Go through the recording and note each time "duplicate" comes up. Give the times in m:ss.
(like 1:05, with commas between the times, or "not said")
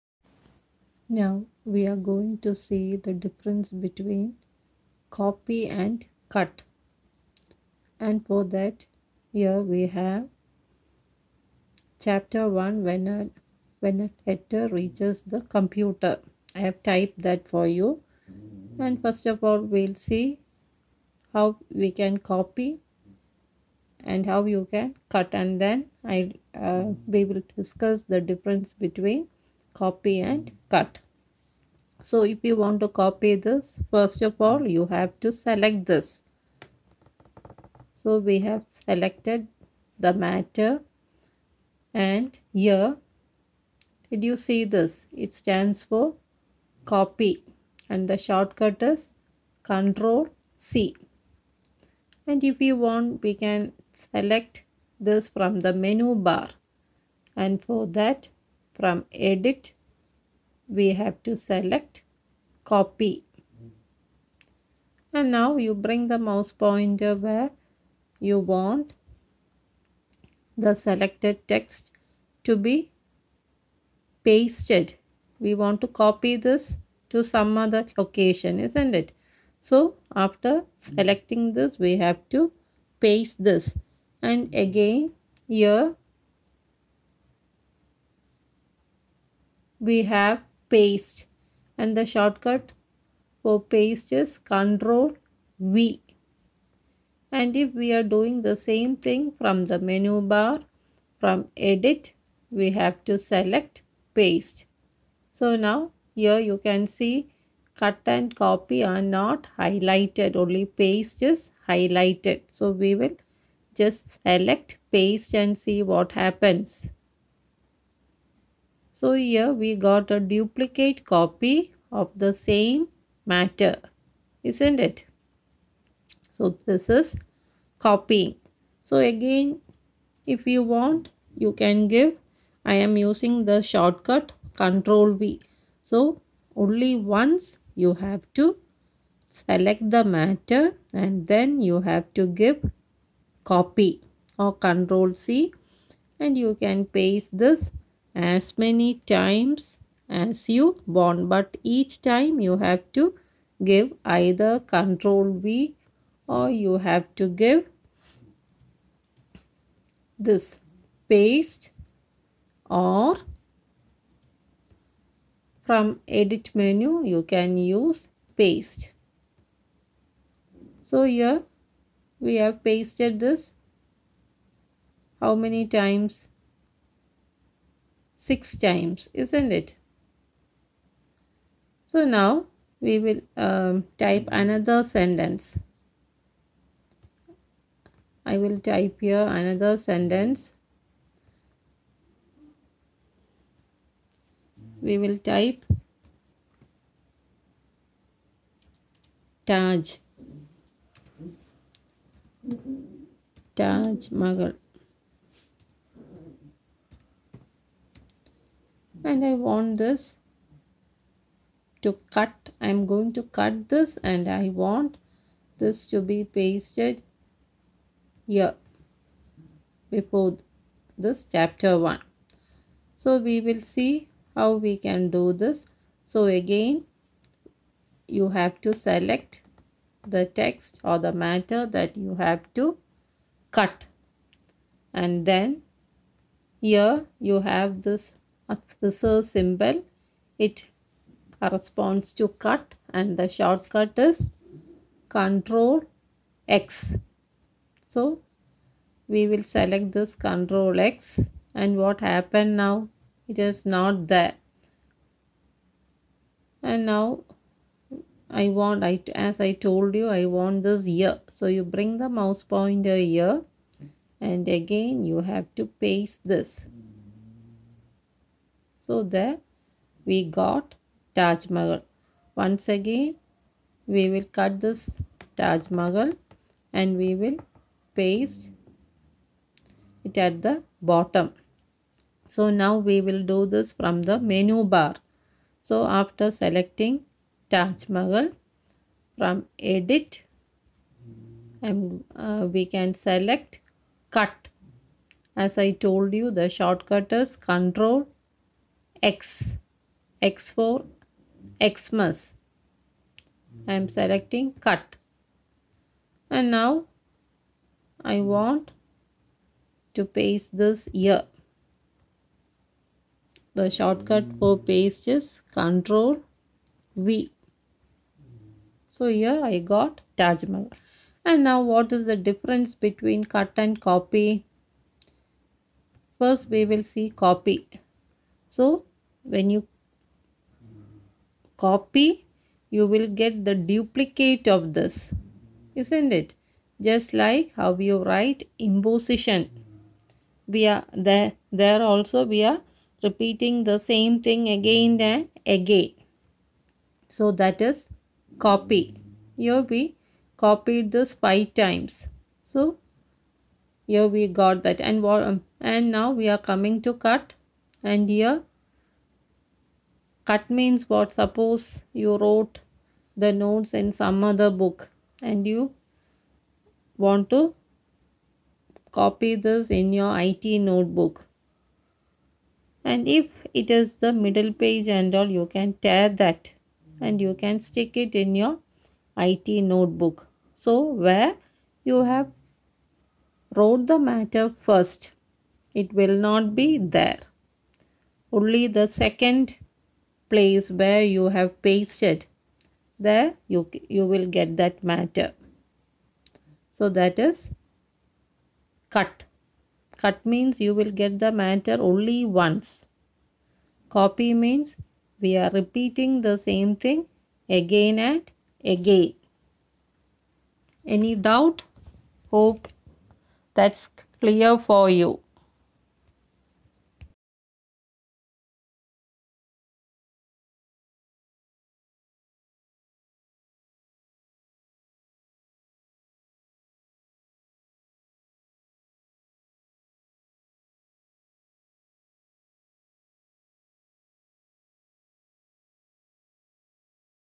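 2:00, 5:33.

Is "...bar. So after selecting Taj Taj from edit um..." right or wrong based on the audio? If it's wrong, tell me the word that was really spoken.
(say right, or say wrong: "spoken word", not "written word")
wrong: "Mahal", not "Taj".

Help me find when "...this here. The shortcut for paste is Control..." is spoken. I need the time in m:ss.
5:10.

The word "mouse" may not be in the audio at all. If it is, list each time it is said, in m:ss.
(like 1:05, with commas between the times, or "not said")
1:06, 4:22.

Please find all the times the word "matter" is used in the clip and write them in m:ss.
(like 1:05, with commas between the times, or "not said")
0:40, 2:03, 2:20, 3:51, 6:24, 6:34, 6:41.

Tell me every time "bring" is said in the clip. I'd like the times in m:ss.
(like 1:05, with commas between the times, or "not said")
1:05, 4:21.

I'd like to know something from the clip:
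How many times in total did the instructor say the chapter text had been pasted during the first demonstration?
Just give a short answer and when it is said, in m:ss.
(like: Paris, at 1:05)
6, at 2:58.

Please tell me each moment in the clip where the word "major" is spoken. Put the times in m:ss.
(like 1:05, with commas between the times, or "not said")
not said.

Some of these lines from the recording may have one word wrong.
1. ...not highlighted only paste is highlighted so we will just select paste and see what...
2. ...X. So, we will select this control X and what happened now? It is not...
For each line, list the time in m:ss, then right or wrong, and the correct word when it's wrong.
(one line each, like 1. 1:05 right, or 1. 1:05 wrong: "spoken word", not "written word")
1. 1:49 right
2. 4:06 right.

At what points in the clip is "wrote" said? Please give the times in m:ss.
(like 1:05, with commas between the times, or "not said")
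6:02, 6:23.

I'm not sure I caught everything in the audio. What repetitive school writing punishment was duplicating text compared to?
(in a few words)
imposition.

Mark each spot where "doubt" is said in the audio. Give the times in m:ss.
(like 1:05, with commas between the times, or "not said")
6:51.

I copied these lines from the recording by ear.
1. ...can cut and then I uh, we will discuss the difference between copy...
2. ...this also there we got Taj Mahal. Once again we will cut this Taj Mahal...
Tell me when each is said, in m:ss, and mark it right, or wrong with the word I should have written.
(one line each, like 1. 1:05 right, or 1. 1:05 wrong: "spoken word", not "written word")
1. 0:24 right
2. 4:26 right.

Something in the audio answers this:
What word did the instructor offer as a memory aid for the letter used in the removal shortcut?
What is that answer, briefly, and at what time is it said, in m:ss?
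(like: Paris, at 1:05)
Xmas, at 5:01.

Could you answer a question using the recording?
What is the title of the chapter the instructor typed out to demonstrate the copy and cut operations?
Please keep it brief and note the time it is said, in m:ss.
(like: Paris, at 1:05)
When a letter reaches the computer, at 0:13.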